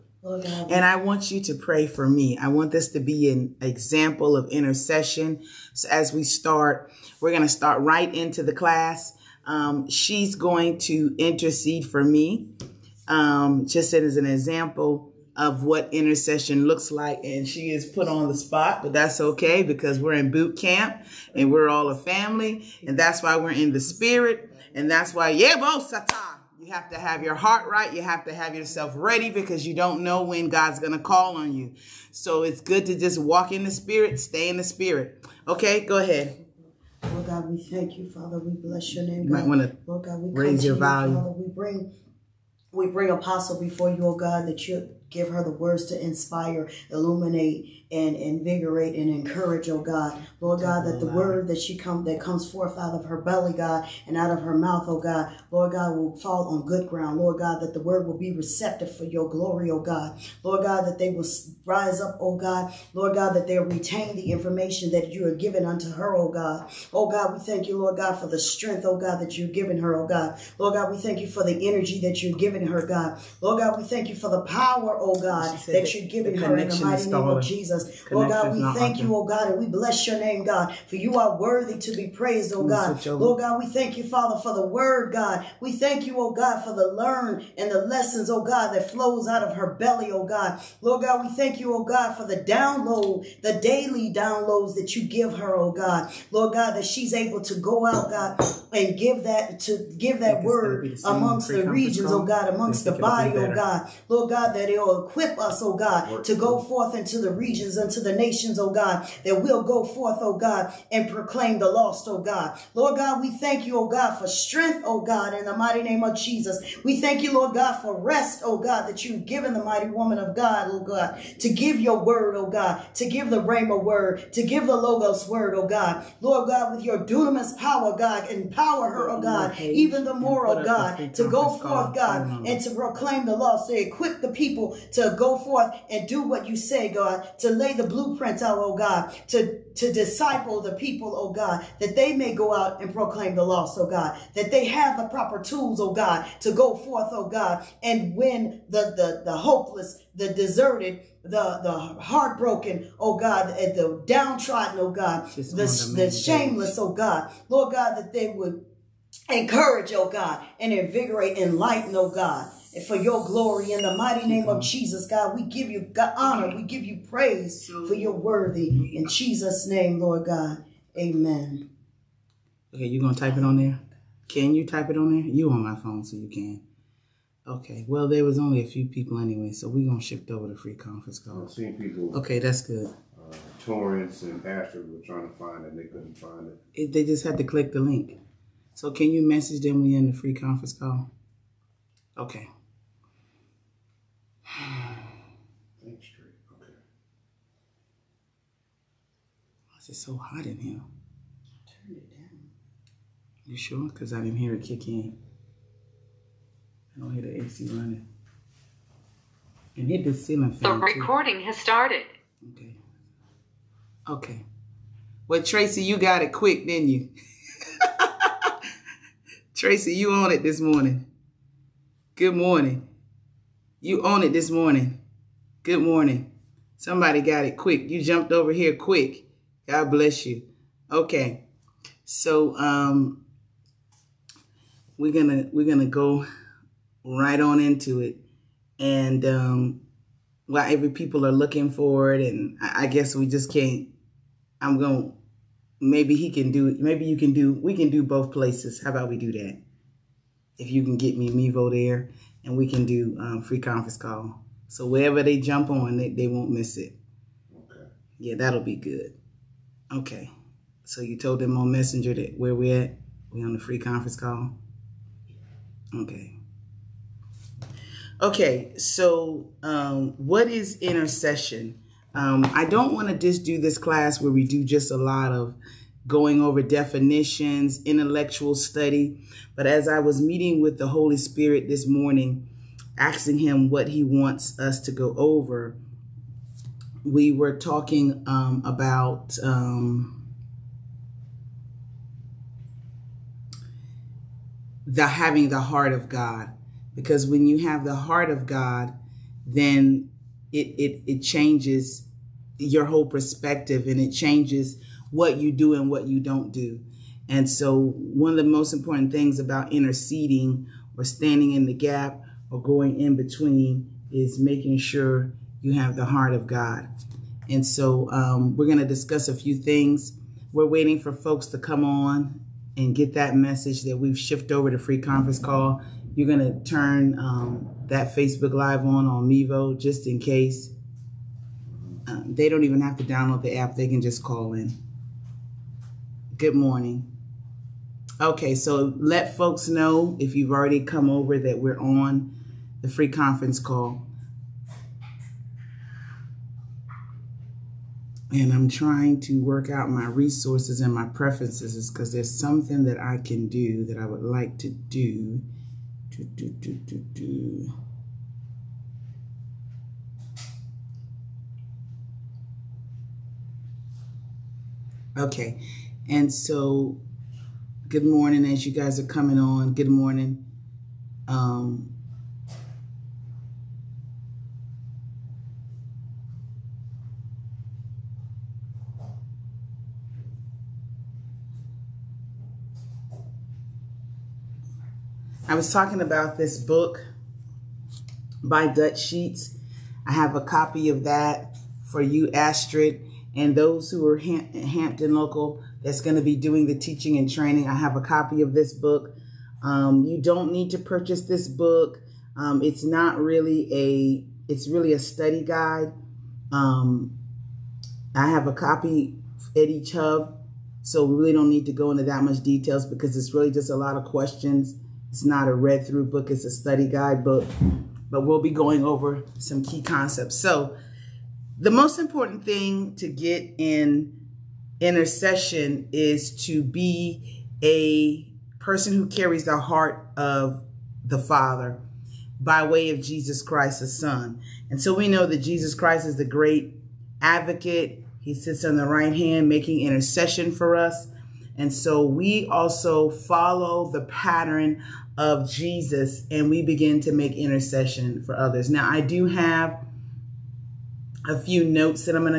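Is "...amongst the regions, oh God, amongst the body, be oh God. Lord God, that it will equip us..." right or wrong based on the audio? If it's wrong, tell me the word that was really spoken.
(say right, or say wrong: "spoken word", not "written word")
right.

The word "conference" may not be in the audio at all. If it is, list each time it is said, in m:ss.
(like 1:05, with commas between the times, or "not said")
3:00, 3:10, 4:13, 4:23, 5:24, 5:43.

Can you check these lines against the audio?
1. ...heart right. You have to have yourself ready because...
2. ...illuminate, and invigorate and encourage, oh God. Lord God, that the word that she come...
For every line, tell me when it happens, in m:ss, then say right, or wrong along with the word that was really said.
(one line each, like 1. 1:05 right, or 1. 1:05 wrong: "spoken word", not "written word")
1. 0:27 right
2. 0:46 right.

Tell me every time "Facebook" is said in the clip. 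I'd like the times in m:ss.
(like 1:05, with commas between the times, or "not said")
5:28.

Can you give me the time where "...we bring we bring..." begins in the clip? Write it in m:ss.
0:41.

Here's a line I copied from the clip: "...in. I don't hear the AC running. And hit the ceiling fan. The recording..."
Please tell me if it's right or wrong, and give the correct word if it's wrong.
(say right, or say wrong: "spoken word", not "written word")
right.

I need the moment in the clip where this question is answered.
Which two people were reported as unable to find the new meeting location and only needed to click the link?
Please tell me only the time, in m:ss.
3:03.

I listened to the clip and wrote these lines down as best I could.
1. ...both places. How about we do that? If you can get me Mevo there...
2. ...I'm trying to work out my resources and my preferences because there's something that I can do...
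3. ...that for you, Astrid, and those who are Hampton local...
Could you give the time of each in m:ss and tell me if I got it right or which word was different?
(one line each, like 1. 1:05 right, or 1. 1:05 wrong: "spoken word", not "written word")
1. 4:08 right
2. 5:48 right
3. 6:31 right.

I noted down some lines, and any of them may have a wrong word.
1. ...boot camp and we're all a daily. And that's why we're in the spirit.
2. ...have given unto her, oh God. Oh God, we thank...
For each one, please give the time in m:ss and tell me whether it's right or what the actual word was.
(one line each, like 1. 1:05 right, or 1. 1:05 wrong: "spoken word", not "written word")
1. 0:20 wrong: "family", not "daily"
2. 1:05 right.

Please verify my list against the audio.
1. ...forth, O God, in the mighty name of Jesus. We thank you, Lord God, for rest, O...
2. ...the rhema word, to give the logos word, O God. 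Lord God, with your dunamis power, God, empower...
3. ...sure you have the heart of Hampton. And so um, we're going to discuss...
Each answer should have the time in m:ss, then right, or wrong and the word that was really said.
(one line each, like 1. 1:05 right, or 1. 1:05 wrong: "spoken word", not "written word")
1. 1:54 wrong: "strength", not "forth"
2. 2:03 right
3. 5:14 wrong: "God", not "Hampton".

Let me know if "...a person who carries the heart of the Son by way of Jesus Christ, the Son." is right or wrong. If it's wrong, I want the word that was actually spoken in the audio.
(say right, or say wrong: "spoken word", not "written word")
wrong: "Father", not "Son".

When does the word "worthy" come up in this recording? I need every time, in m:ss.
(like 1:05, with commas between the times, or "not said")
1:21, 2:48.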